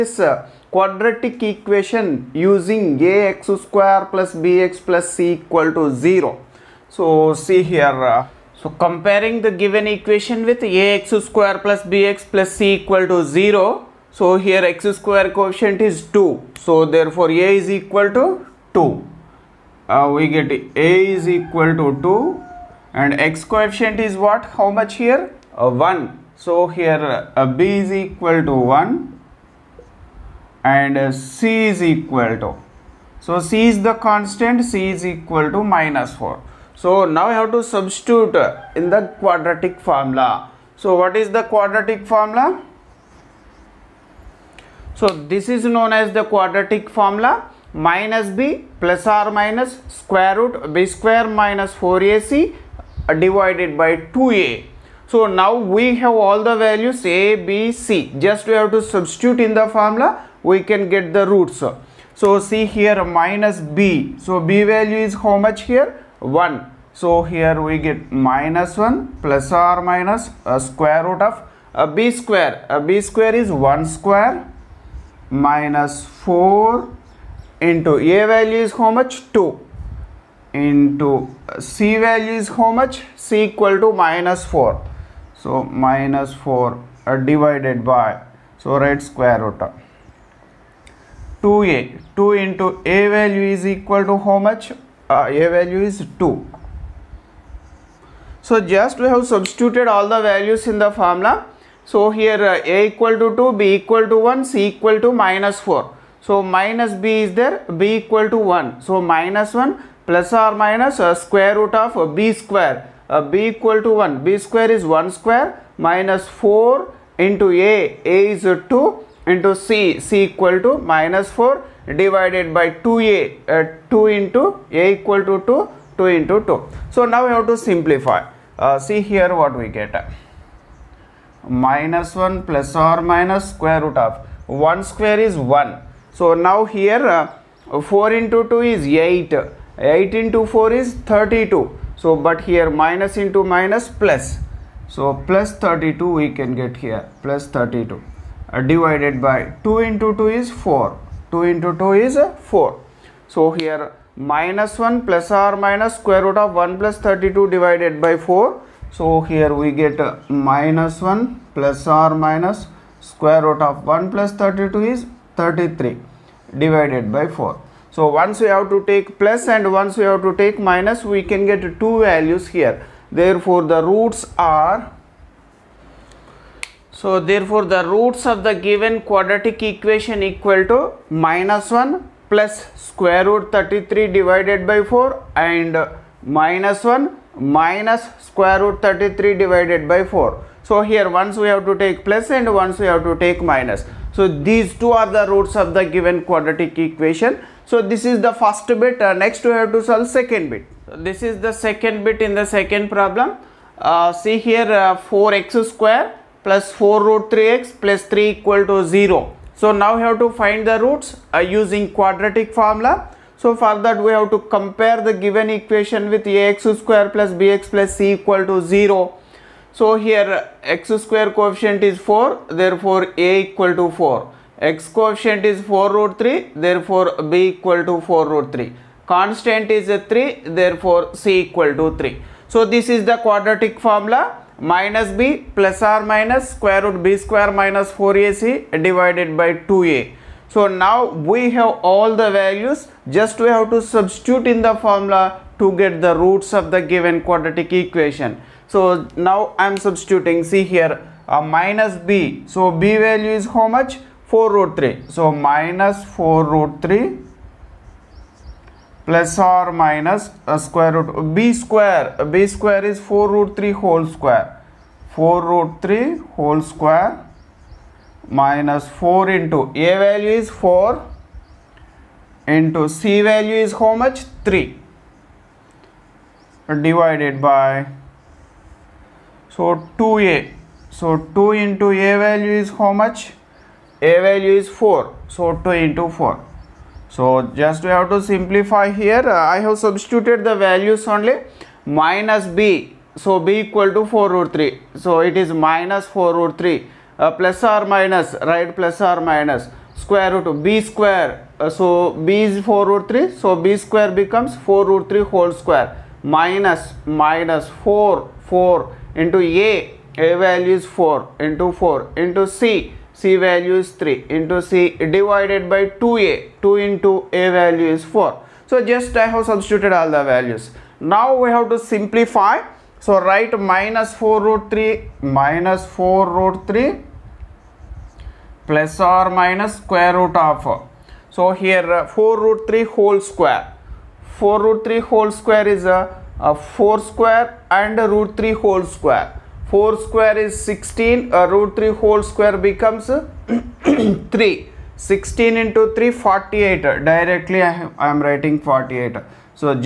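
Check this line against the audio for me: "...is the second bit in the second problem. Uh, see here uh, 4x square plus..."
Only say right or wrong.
right.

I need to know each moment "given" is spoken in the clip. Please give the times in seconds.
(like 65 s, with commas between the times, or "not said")
9 s, 178 s, 195 s, 215 s, 246 s.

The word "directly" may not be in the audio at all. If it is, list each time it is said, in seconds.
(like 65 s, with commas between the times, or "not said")
347 s.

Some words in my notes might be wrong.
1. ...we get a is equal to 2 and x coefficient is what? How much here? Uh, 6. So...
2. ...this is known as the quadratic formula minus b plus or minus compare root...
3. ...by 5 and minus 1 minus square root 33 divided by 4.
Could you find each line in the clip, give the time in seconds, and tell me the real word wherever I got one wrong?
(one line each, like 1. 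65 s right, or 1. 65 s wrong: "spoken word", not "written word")
1. 20 s wrong: "1", not "6"
2. 45 s wrong: "square", not "compare"
3. 184 s wrong: "4", not "5".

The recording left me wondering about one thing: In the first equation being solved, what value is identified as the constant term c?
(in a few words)
-4.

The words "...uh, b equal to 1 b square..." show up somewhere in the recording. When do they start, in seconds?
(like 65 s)
113 s.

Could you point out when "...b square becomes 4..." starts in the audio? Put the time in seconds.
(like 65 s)
303 s.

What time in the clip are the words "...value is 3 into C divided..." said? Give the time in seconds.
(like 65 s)
313 s.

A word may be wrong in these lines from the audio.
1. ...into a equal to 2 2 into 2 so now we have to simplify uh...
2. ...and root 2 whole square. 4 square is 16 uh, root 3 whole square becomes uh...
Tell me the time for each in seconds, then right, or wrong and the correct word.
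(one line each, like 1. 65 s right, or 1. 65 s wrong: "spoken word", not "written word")
1. 124 s right
2. 337 s wrong: "3", not "2".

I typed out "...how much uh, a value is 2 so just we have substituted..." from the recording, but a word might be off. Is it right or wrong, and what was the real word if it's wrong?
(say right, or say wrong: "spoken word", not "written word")
right.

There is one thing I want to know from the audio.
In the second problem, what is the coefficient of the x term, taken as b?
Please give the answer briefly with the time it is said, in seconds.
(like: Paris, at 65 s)
4 root 3, at 225 s.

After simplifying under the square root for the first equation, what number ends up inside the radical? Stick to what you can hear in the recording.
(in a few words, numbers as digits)
33.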